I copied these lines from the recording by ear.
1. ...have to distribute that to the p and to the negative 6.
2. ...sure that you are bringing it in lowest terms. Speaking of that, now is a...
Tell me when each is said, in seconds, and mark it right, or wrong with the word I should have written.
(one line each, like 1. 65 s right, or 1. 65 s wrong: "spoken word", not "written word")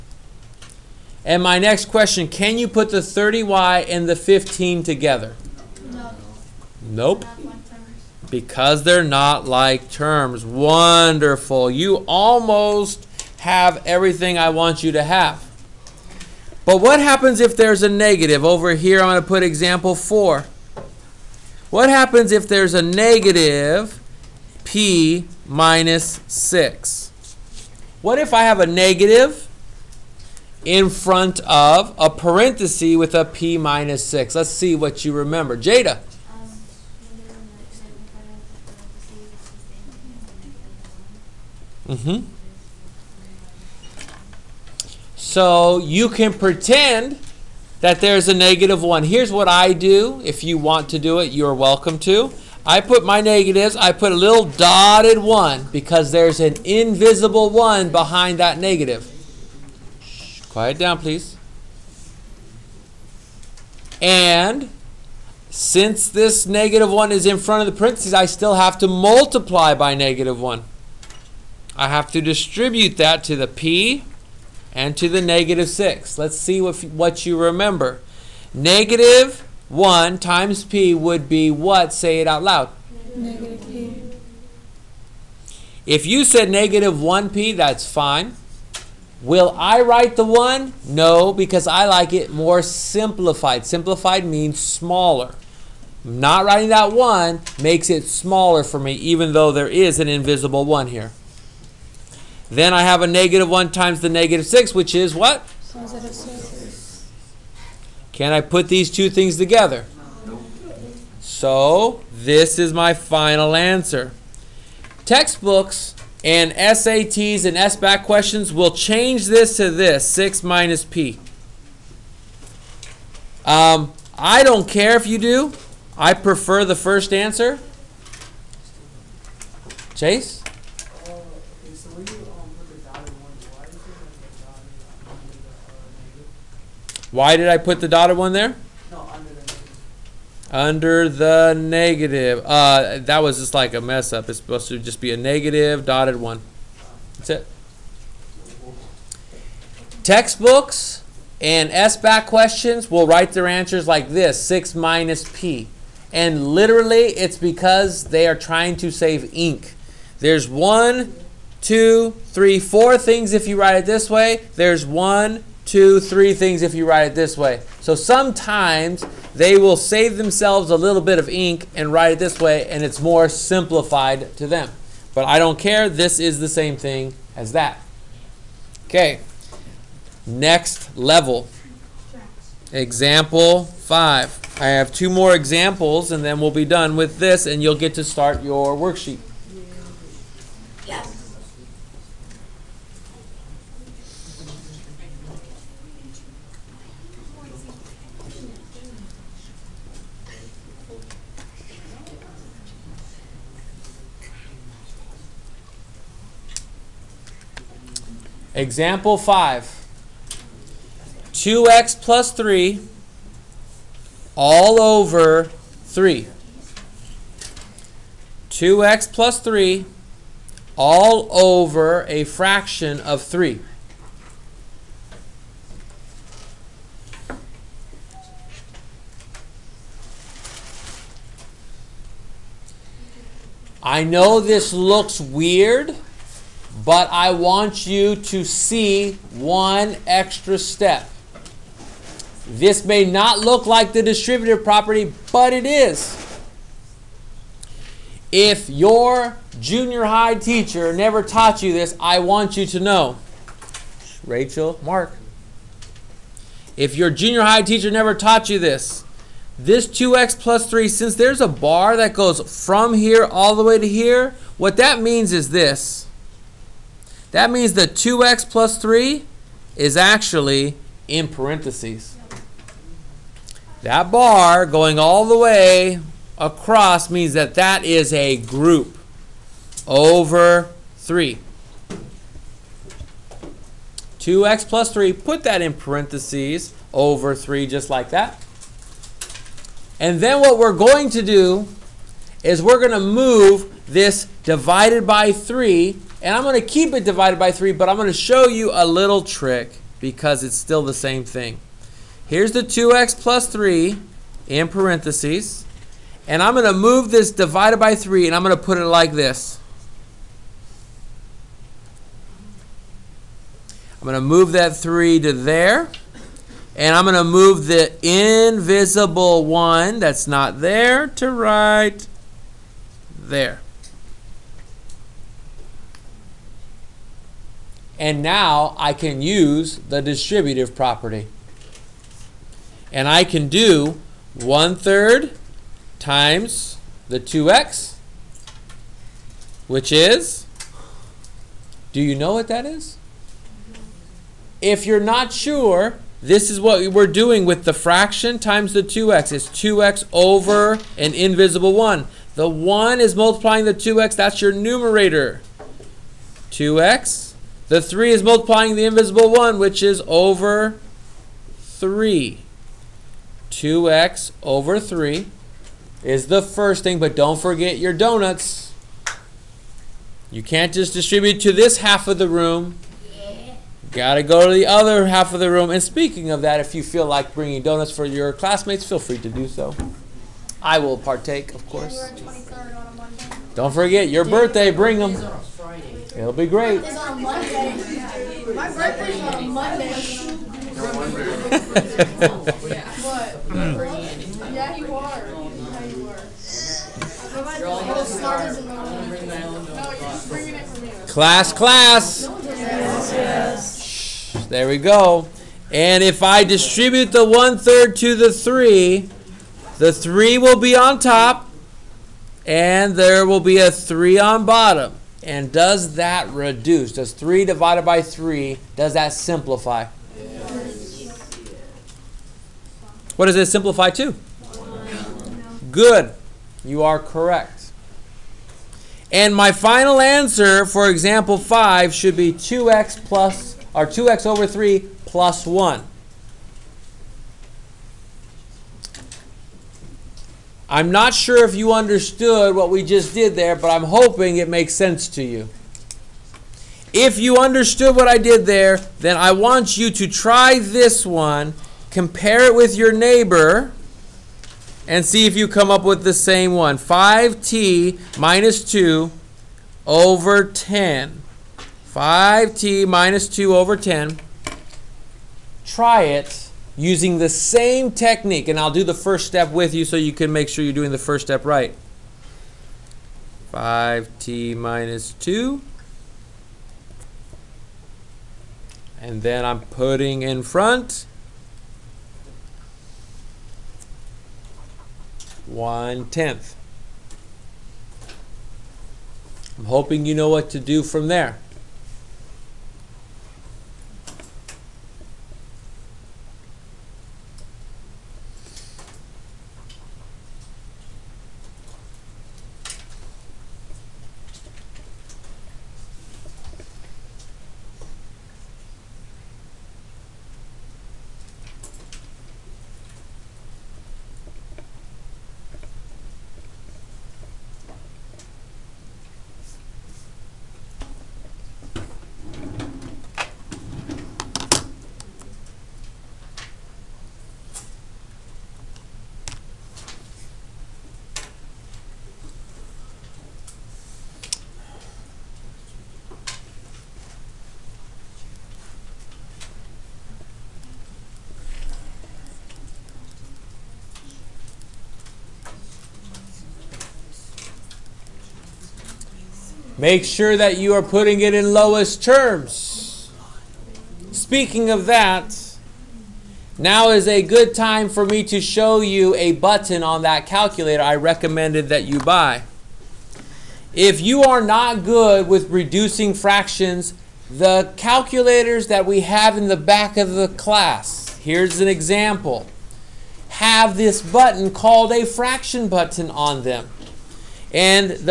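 1. 71 s right
2. 550 s wrong: "putting", not "bringing".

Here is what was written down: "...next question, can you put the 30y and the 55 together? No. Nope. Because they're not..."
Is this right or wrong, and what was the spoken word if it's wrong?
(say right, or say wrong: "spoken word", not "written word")
wrong: "15", not "55".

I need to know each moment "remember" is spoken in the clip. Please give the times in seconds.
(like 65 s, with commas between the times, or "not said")
35 s, 77 s.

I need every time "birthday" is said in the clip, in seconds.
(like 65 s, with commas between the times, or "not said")
384 s, 388 s.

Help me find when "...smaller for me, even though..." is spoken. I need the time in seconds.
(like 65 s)
98 s.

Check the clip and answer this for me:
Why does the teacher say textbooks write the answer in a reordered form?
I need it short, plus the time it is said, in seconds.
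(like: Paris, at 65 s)
to save ink, at 158 s.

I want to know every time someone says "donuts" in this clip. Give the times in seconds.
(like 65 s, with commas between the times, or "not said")
367 s, 377 s.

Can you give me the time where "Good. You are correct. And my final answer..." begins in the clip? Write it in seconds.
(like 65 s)
425 s.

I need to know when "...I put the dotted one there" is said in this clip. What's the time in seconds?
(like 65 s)
137 s.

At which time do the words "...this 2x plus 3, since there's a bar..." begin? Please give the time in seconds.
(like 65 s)
259 s.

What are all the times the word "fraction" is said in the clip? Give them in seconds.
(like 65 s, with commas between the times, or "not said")
222 s, 347 s, 566 s, 575 s.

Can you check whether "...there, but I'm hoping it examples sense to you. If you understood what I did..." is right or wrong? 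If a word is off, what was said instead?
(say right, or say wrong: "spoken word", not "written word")
wrong: "makes", not "examples".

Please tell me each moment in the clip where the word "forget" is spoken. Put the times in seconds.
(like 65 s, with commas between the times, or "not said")
367 s, 383 s.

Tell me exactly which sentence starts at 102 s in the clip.
Then I have a negative 1 times the negative 6, which is what?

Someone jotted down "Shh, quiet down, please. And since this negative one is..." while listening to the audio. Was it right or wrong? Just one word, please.
right.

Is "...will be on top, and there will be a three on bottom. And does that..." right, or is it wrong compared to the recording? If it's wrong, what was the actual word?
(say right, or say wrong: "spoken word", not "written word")
right.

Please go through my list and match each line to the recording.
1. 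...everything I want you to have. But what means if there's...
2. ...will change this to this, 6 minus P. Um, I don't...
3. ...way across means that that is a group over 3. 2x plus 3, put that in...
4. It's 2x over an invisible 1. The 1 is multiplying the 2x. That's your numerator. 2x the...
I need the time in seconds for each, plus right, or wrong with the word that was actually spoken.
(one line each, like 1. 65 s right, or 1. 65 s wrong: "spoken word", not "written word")
1. 13 s wrong: "happens", not "means"
2. 118 s right
3. 275 s right
4. 349 s right.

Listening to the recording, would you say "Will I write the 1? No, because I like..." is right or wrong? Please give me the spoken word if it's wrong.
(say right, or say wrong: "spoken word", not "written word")
right.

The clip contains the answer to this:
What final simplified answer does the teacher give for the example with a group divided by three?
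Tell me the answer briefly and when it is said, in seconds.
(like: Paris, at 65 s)
2x over 3 plus 1, at 433 s.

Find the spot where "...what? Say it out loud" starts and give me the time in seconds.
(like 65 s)
81 s.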